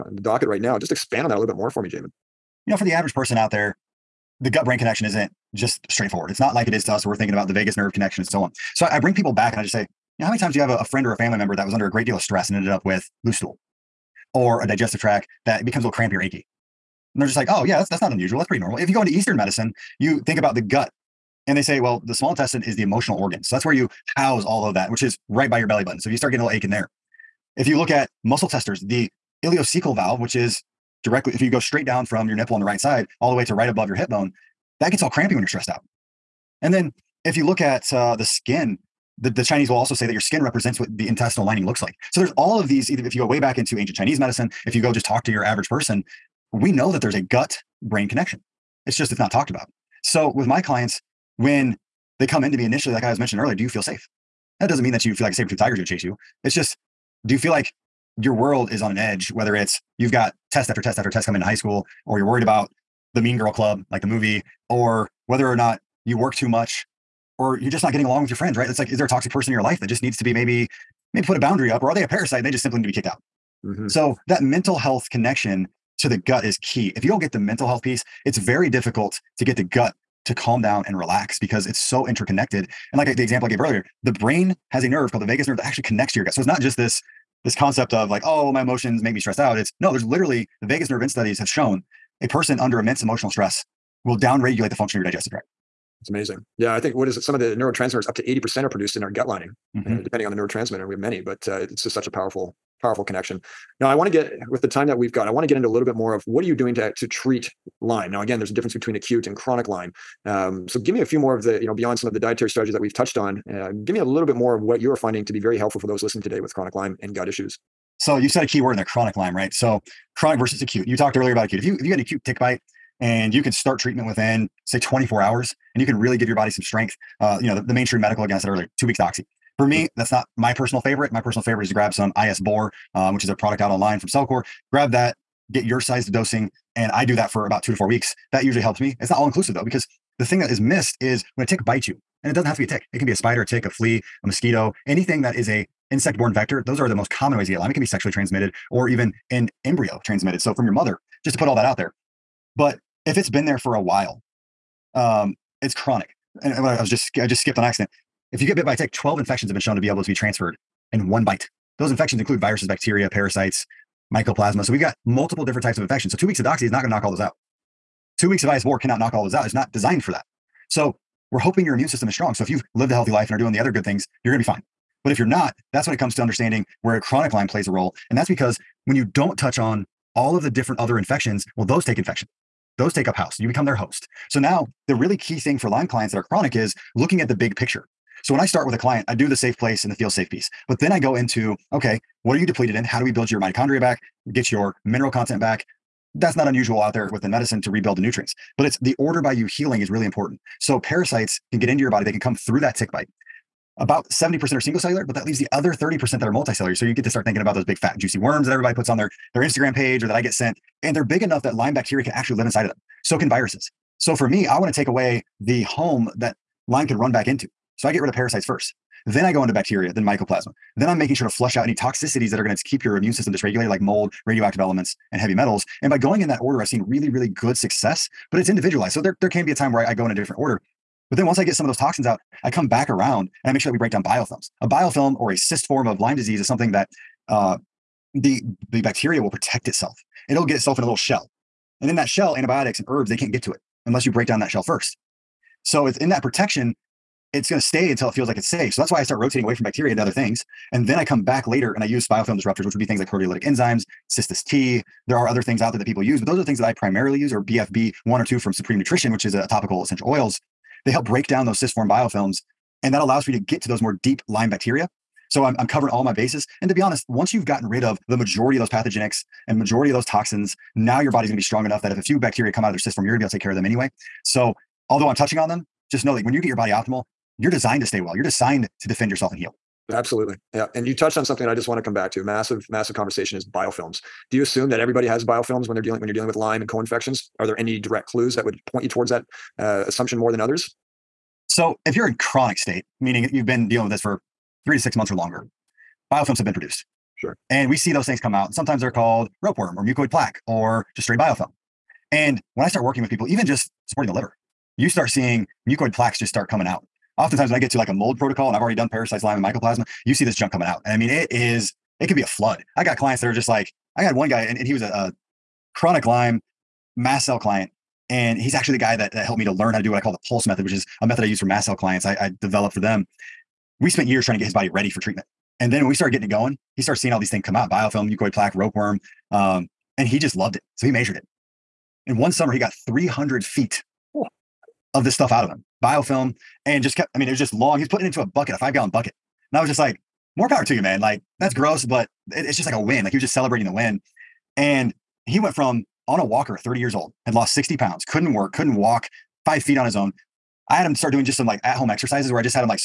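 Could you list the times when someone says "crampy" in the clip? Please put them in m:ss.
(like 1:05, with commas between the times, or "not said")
0:15, 0:35.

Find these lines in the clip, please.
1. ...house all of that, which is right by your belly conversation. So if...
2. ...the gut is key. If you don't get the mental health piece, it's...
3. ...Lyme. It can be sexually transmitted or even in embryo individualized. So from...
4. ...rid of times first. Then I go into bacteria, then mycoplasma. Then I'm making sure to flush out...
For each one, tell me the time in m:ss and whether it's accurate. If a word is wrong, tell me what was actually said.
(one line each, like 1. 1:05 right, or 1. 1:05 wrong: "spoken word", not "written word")
1. 0:24 wrong: "button", not "conversation"
2. 1:16 right
3. 2:27 wrong: "transmitted", not "individualized"
4. 3:38 wrong: "parasites", not "times".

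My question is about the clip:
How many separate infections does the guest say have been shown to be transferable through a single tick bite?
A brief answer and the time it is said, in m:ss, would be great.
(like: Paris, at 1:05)
12, at 2:38.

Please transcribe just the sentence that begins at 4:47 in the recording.
Are there any direct clues that would point you towards that uh, assumption more than others?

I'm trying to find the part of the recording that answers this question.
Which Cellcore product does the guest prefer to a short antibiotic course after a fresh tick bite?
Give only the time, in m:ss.
2:12.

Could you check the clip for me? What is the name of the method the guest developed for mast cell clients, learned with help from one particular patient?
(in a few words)
the pulse method.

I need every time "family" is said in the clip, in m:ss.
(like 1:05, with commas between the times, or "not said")
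0:11.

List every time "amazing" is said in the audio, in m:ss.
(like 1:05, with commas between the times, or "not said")
1:36.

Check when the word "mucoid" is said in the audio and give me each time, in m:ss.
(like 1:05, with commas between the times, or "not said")
4:59, 5:05, 5:28.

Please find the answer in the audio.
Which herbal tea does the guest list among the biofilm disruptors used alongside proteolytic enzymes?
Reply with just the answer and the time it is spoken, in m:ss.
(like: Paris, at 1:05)
cistus tea, at 4:14.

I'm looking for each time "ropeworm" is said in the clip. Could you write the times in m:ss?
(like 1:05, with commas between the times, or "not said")
4:59, 5:28.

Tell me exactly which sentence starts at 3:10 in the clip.
But then I go into, okay, what are you depleted in?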